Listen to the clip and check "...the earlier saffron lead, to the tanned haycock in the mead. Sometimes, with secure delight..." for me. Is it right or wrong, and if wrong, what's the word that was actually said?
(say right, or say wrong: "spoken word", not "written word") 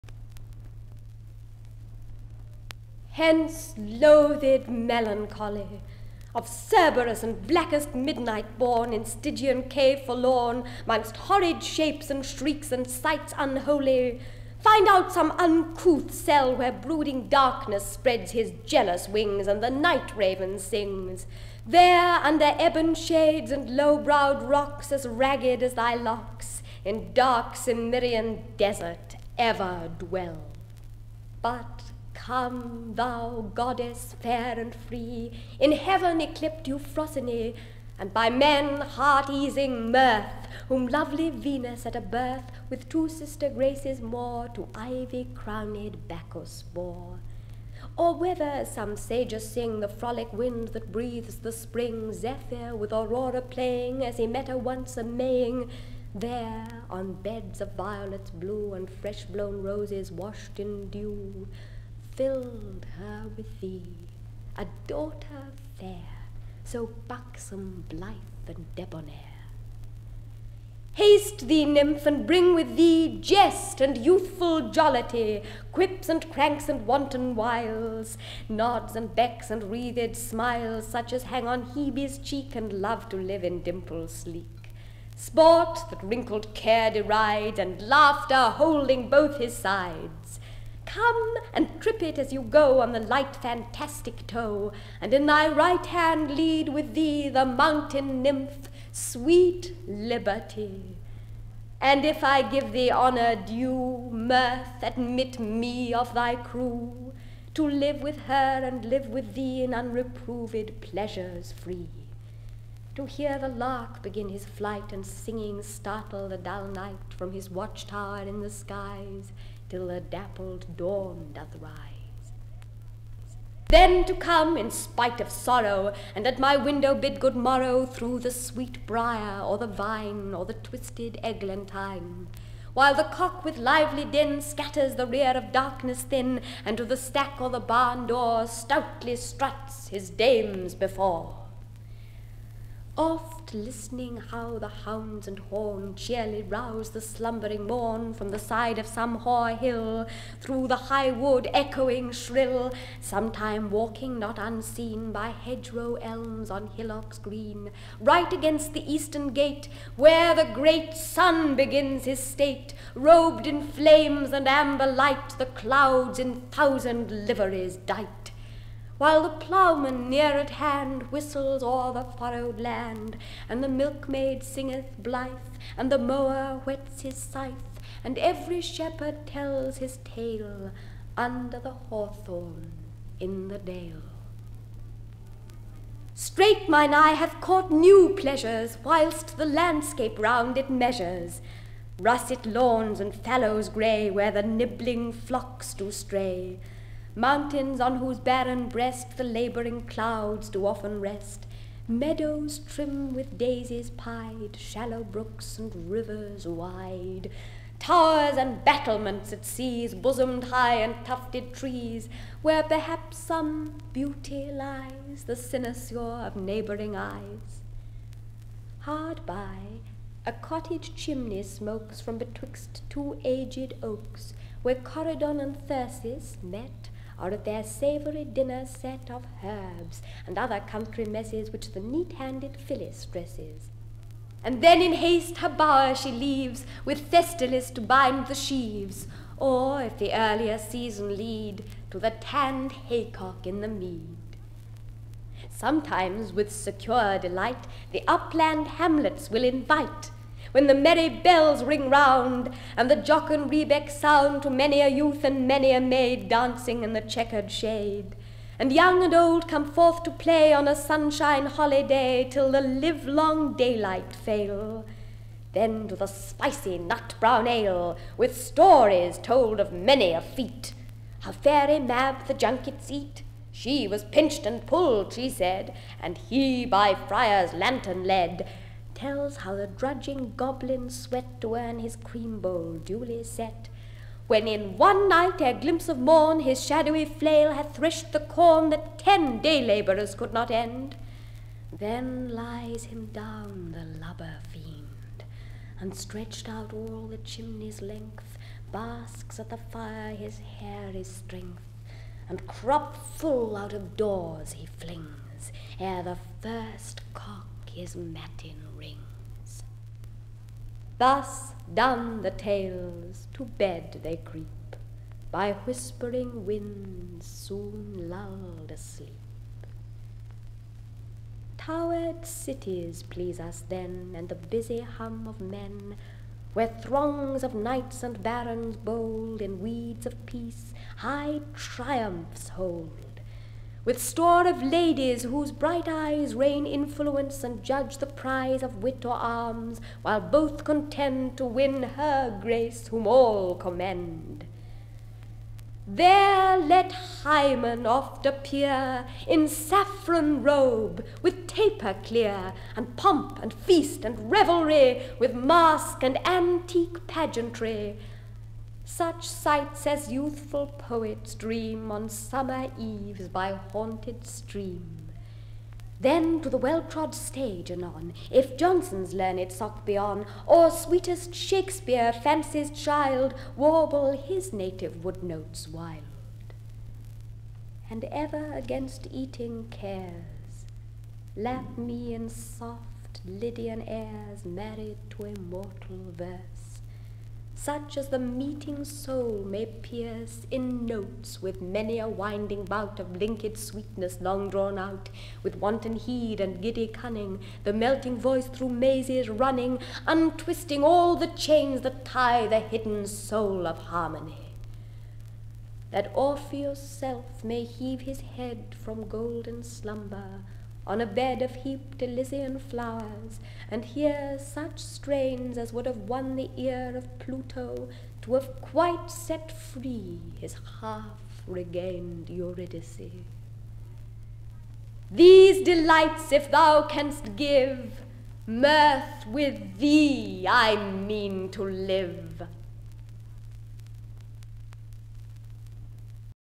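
wrong: "season", not "saffron".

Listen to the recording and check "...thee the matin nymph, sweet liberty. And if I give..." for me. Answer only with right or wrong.
wrong.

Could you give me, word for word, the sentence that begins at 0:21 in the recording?
There, under ebon shades and low browed rocks as ragged as thy locks, in dark Cimmerian desert ever dwell.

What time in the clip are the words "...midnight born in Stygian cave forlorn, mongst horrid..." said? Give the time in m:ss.
0:07.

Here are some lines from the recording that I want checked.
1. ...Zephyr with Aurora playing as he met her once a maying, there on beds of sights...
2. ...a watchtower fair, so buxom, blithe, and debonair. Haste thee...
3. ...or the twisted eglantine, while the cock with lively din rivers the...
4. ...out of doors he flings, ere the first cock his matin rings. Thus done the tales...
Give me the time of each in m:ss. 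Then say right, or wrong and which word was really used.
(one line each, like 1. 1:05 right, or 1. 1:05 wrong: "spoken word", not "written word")
1. 0:52 wrong: "violets", not "sights"
2. 1:04 wrong: "daughter", not "watchtower"
3. 2:10 wrong: "scatters", not "rivers"
4. 5:03 right.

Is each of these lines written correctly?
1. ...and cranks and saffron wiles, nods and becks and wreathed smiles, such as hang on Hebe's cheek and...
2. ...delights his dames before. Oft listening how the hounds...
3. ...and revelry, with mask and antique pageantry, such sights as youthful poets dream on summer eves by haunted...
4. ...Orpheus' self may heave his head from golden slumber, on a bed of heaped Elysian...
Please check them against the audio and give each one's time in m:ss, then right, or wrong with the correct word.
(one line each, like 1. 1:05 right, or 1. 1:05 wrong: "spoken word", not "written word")
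1. 1:16 wrong: "wanton", not "saffron"
2. 2:19 wrong: "struts", not "delights"
3. 5:54 right
4. 6:46 right.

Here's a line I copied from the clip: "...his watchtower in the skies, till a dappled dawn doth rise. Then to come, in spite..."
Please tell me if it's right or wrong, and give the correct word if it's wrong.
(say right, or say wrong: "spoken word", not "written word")
right.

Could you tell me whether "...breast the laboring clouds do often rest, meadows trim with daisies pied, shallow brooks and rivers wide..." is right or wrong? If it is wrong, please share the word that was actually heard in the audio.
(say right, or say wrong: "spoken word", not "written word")
right.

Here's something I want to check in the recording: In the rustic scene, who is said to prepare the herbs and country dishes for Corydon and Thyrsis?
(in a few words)
Phyllis.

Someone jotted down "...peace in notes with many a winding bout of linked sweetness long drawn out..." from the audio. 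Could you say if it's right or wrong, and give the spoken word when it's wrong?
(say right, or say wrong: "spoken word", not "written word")
wrong: "pierce", not "peace".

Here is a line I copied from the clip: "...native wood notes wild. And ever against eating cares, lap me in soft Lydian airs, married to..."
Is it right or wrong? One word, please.
right.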